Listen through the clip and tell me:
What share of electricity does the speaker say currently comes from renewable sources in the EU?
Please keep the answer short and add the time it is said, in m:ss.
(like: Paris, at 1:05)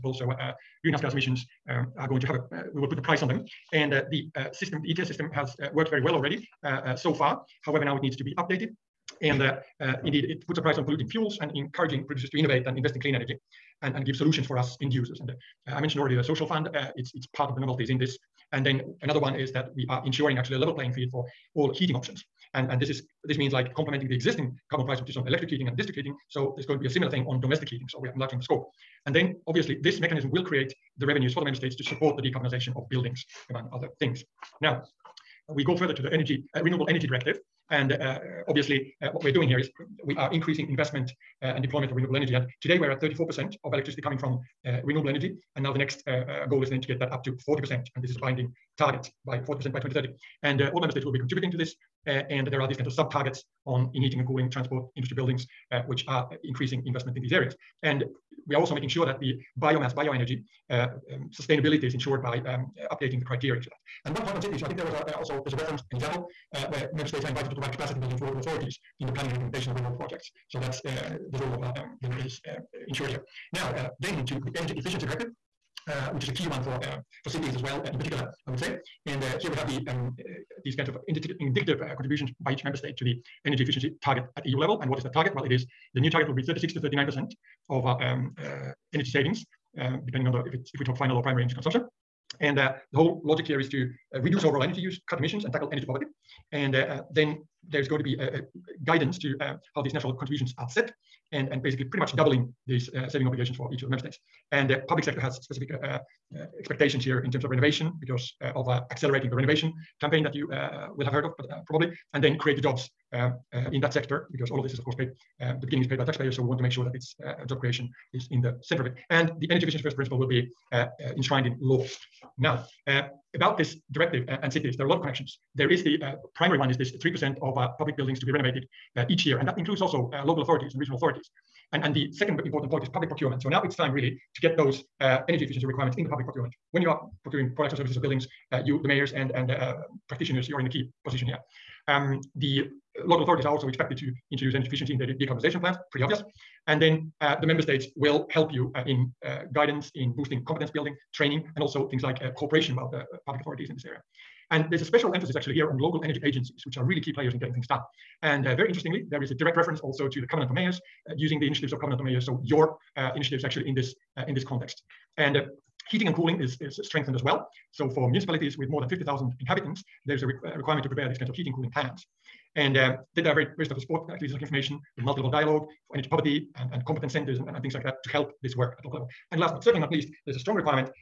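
34%, at 0:43.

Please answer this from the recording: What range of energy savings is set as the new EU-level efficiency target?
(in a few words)
36 to 39%.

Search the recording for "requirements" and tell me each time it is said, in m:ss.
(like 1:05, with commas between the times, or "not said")
2:15, 2:50.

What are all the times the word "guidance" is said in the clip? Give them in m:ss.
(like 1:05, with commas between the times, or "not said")
1:38, 2:29.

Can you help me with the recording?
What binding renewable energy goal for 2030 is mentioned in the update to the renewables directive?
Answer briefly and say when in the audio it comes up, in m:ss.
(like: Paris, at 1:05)
40%, at 0:49.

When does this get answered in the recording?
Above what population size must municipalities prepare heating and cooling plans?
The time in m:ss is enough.
2:48.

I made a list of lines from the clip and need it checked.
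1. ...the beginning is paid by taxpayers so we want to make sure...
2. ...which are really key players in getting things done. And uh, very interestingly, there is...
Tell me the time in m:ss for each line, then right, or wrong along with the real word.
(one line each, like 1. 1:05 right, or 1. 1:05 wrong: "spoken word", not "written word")
1. 1:55 right
2. 2:36 right.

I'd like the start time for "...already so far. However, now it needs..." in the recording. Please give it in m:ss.
0:06.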